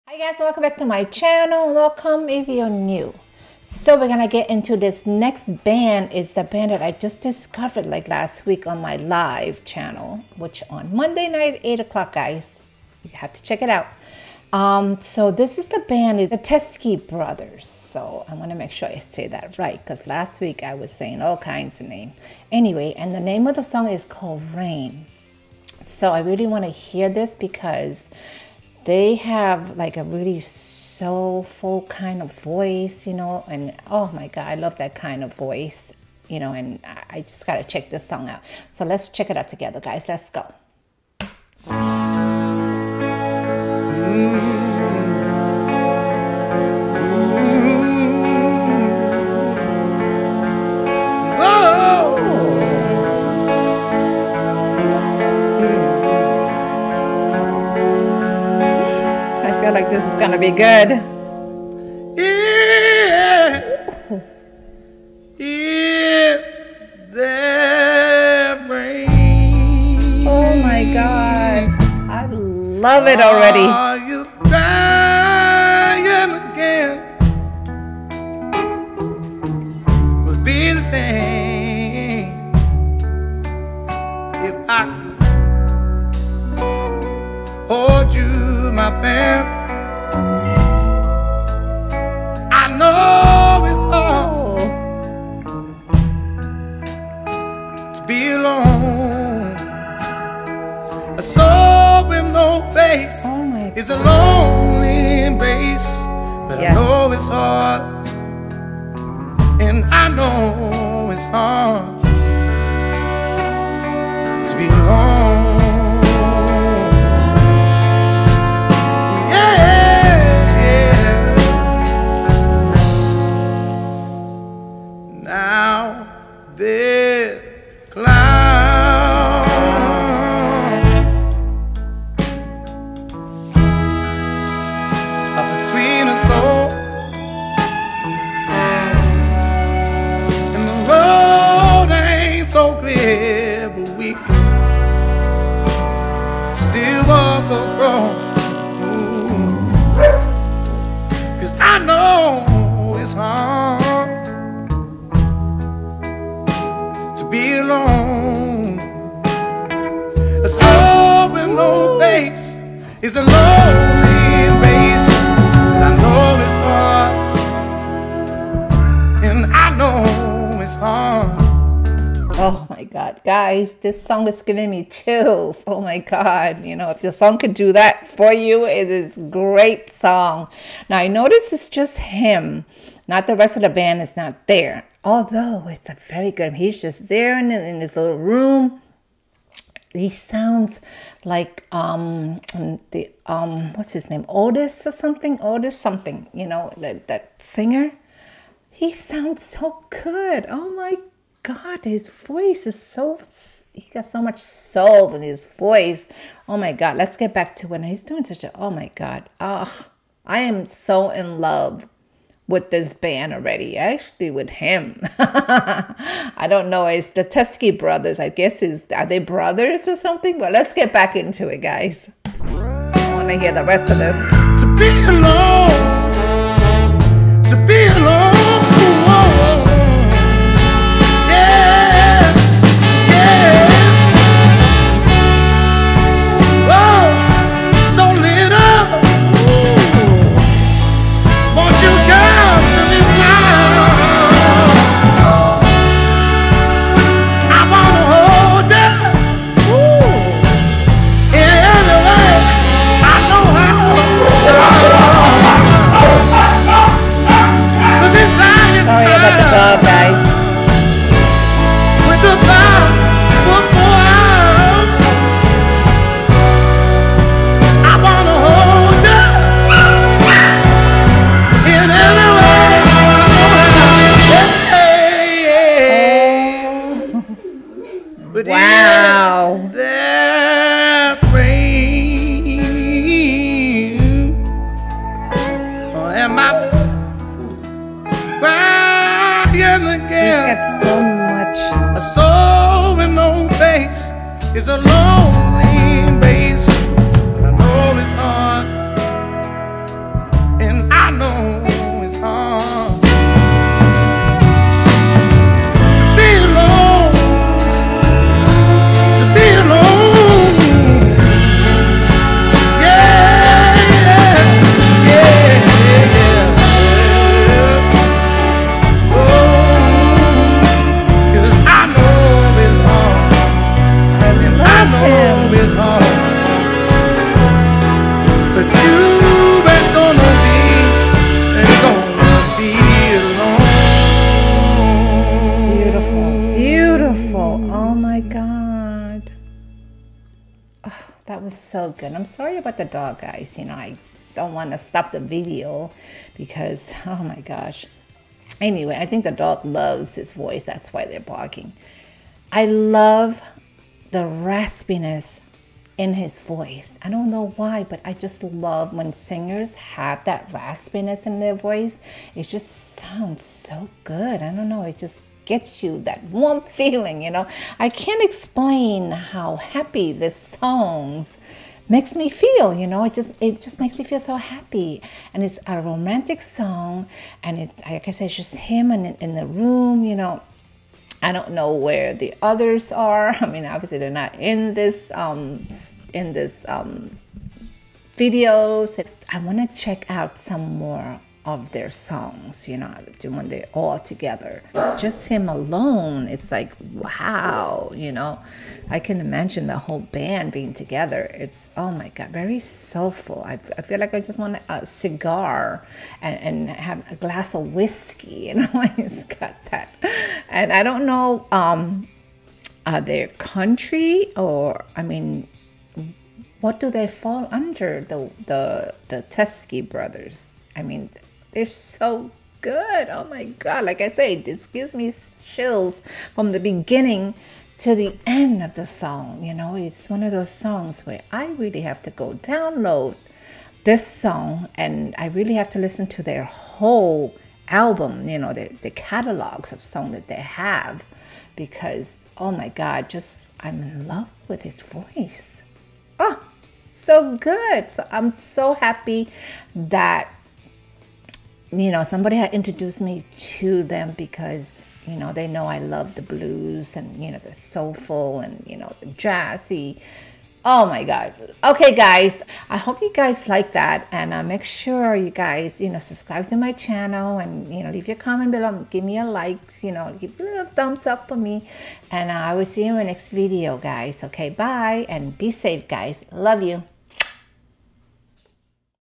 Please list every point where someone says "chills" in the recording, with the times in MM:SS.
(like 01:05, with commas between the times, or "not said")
02:54, 07:05.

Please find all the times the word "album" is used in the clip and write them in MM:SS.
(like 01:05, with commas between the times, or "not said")
07:17.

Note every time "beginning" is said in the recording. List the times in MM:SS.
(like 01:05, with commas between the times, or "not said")
07:06.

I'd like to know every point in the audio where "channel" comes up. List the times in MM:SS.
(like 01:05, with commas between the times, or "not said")
00:01, 00:09, 07:46.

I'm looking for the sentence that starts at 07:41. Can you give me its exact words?
Okay, guys, I hope you guys like that.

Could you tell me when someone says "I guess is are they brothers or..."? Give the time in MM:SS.
03:38.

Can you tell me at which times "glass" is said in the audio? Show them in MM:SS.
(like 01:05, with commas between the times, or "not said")
06:47.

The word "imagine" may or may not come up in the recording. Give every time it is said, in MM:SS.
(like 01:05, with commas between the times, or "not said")
06:39.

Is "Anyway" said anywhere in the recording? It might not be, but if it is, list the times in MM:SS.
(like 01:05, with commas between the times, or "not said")
00:22, 05:48.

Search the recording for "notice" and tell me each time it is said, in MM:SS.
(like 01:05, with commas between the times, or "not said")
03:01.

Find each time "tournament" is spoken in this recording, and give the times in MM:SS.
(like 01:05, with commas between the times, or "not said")
not said.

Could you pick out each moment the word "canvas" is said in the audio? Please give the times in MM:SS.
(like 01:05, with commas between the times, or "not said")
not said.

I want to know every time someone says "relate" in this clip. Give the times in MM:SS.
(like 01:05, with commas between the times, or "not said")
not said.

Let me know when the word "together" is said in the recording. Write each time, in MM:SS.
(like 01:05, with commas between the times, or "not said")
00:39, 06:33, 06:40.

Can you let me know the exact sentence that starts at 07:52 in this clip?
And uh, I will see you in the next video, guys.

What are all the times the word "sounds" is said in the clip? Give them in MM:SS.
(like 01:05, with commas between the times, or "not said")
03:10, 03:18, 06:02.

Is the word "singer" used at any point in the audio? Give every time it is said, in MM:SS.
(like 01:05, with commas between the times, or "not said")
03:17, 05:59.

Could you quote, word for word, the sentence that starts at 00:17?
So I want to make sure I say that right because last week I was saying all kinds of names.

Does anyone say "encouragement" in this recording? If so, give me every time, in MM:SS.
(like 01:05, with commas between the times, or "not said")
not said.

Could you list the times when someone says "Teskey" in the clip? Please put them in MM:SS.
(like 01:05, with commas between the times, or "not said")
00:16, 03:37, 06:59.